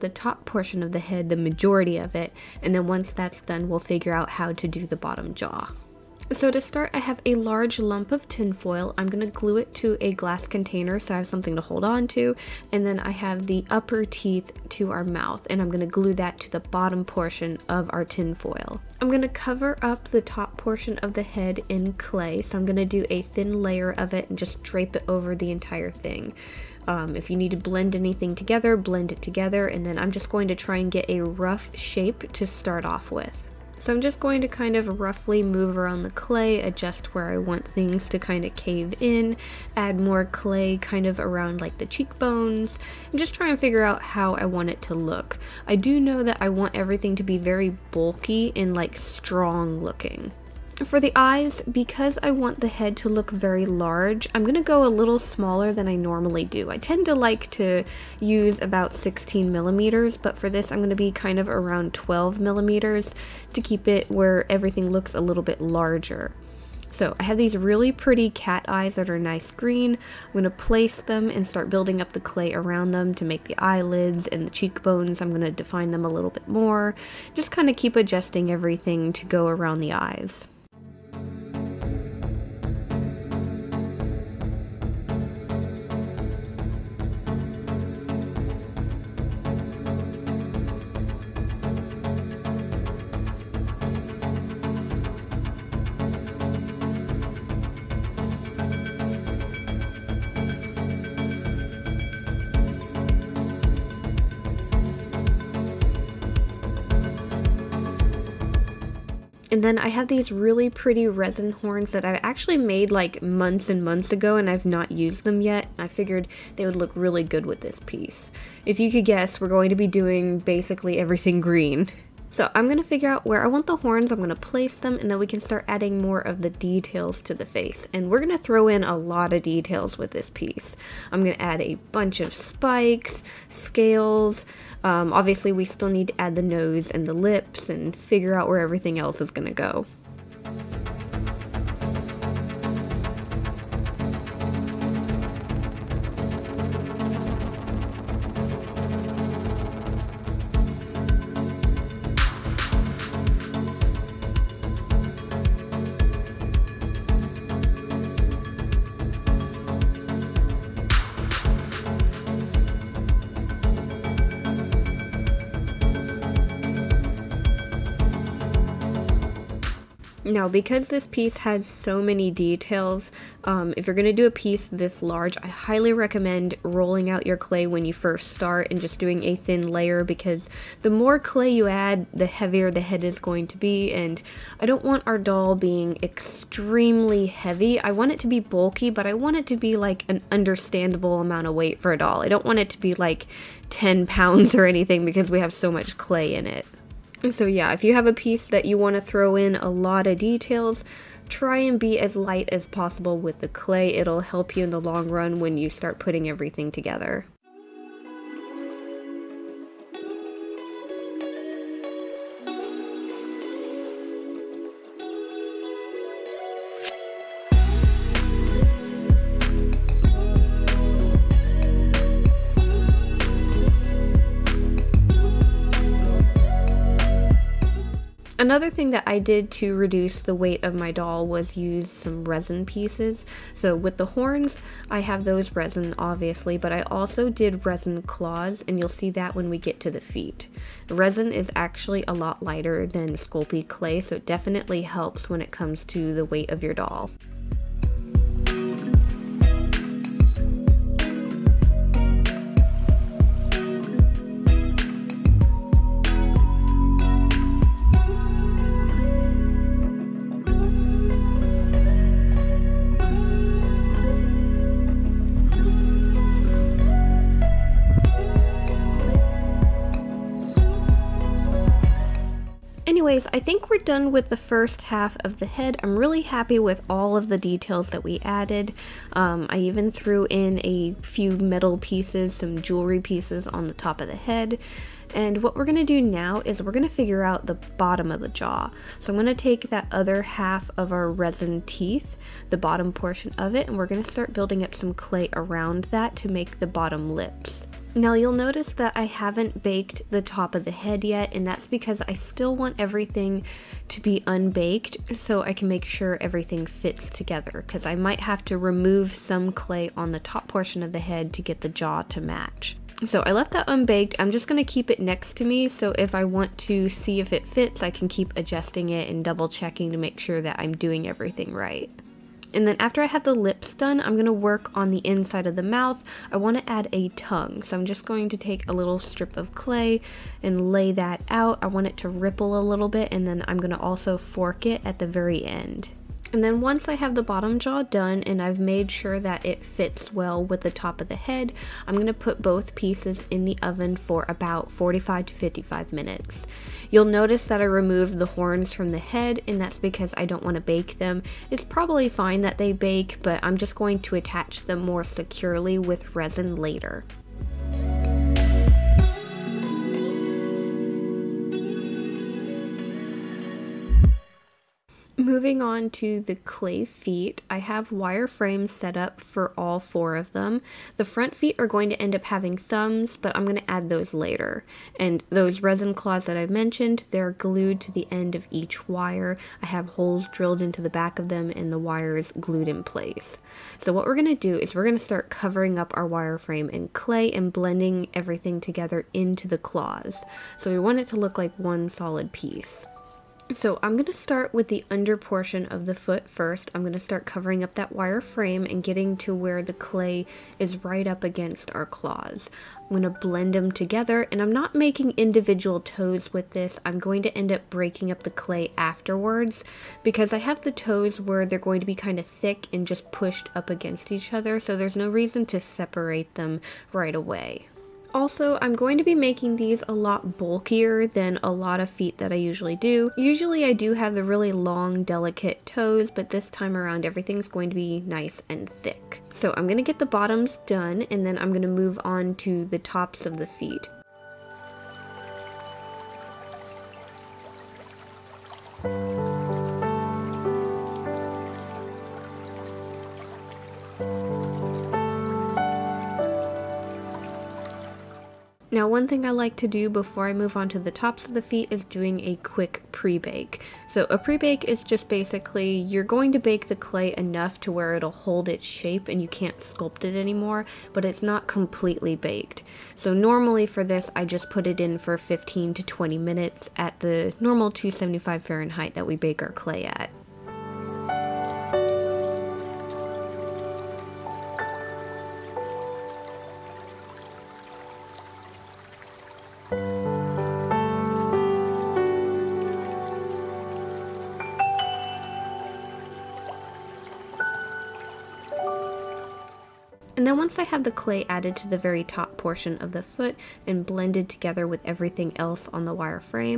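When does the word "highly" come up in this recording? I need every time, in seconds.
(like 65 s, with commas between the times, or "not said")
175 s.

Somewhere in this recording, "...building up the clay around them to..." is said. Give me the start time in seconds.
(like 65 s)
71 s.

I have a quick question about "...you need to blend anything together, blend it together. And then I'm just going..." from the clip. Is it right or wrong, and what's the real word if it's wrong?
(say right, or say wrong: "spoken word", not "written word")
right.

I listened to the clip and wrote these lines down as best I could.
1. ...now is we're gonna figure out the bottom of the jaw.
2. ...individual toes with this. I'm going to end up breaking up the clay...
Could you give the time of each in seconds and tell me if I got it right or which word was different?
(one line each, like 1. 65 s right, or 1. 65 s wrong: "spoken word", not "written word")
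1. 286 s right
2. 405 s right.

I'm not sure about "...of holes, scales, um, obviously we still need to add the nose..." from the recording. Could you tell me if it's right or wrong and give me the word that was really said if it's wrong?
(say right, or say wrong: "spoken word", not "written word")
wrong: "spikes", not "holes".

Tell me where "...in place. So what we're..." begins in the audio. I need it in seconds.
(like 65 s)
382 s.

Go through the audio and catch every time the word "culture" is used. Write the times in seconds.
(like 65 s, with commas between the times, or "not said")
not said.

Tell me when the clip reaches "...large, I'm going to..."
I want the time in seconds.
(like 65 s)
53 s.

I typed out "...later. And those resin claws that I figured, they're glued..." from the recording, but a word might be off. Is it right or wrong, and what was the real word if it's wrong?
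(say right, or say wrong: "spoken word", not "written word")
wrong: "mentioned", not "figured".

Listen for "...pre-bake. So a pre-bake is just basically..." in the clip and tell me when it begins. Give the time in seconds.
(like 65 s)
452 s.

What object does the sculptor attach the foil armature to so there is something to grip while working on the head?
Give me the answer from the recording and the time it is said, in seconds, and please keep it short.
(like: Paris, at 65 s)
glass container, at 10 s.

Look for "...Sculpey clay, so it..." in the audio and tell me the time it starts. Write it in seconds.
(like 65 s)
243 s.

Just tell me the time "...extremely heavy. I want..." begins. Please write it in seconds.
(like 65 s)
186 s.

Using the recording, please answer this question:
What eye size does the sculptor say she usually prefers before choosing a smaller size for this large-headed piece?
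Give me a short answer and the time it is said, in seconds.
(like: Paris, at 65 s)
16 millimeters, at 58 s.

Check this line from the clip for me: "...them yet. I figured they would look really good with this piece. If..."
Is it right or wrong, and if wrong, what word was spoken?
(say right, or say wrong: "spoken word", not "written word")
right.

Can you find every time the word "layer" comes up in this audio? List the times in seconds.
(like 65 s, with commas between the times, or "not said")
23 s, 179 s.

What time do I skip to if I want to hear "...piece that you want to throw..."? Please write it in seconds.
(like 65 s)
198 s.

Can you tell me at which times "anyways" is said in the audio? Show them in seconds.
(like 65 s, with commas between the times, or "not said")
273 s.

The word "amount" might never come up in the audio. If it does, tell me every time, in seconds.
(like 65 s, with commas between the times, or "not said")
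191 s.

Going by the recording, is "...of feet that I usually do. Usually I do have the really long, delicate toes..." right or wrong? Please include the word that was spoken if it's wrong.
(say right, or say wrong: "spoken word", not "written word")
right.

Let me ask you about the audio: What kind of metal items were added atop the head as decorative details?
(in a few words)
jewelry pieces.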